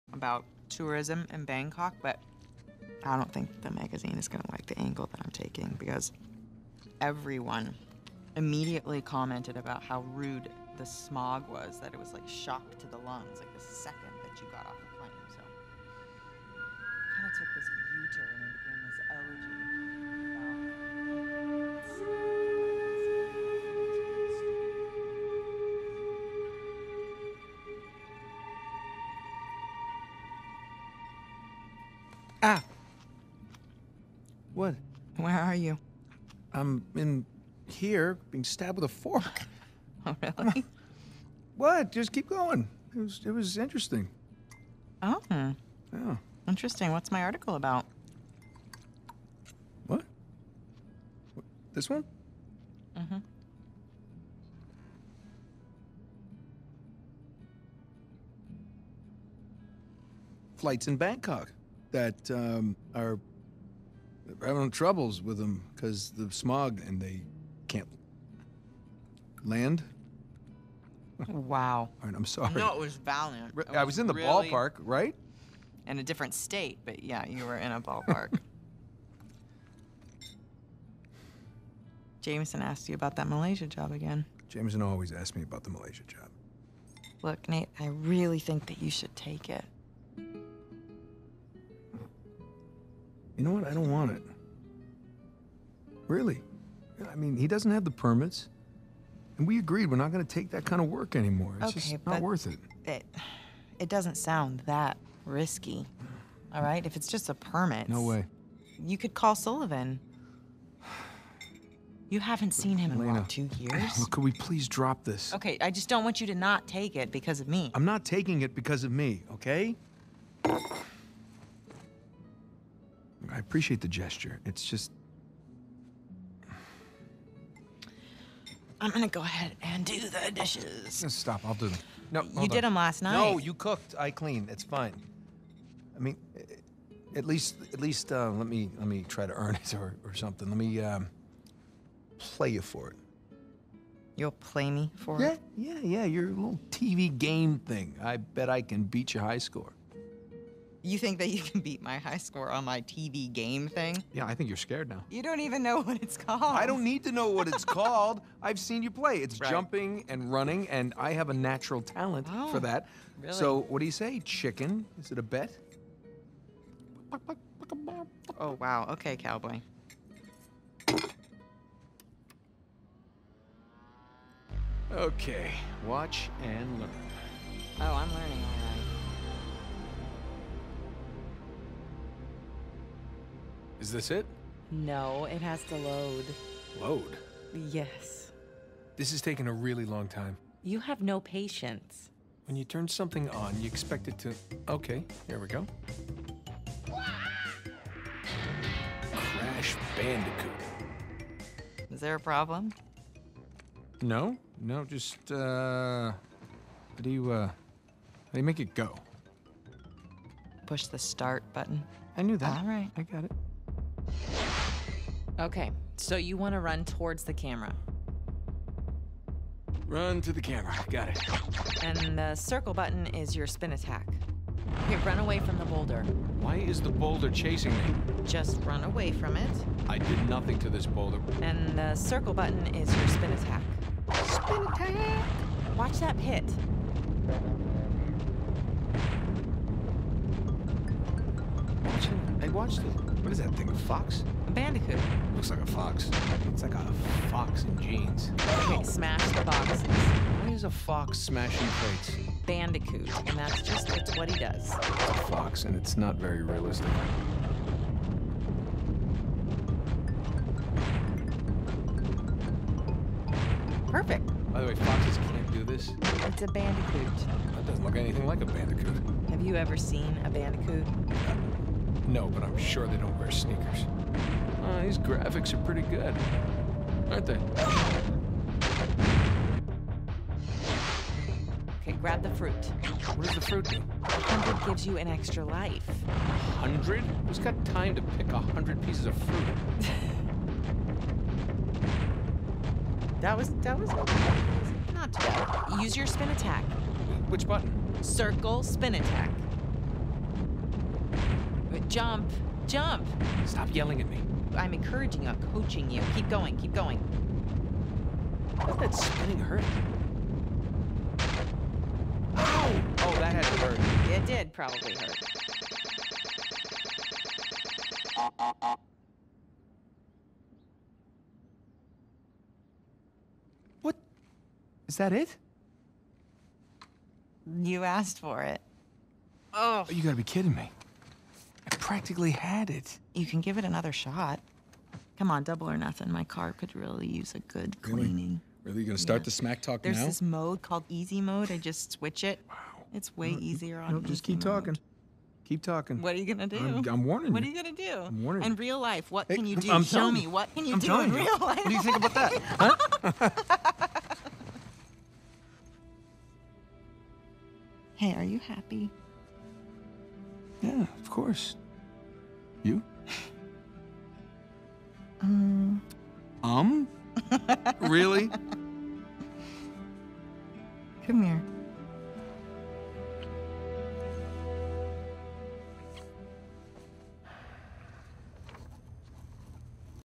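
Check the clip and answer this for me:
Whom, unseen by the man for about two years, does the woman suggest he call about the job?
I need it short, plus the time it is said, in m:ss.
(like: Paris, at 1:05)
Sullivan, at 1:49.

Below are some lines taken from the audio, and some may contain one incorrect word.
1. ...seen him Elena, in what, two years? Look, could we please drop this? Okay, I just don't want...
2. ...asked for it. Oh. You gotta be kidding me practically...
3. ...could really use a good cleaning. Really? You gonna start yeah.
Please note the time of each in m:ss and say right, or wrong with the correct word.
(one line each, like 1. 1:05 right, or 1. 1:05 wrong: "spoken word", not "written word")
1. 1:52 right
2. 5:27 right
3. 5:36 right.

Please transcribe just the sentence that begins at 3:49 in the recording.
I did nothing to this boulder.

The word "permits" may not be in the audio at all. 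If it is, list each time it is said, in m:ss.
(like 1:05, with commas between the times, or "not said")
1:37, 1:47.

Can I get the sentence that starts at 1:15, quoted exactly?
In a different state, but yeah, you were in a ballpark.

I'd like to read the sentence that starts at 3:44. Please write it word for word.
Okay, run away from the boulder.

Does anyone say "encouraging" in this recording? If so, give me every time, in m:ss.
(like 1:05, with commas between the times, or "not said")
5:04.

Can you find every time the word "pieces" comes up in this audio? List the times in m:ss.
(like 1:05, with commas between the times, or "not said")
4:48.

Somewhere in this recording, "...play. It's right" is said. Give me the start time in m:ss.
2:38.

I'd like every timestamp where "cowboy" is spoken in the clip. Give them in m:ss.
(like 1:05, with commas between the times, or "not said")
2:49.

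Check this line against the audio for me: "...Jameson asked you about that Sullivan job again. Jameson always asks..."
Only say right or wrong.
wrong.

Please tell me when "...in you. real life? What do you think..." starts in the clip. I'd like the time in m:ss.
5:51.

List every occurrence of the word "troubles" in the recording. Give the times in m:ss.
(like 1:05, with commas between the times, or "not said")
1:04.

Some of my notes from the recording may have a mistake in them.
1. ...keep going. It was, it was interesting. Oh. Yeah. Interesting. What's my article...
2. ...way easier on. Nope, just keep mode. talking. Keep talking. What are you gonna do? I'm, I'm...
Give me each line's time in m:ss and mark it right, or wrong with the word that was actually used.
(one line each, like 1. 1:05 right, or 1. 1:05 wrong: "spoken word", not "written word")
1. 0:42 right
2. 5:43 right.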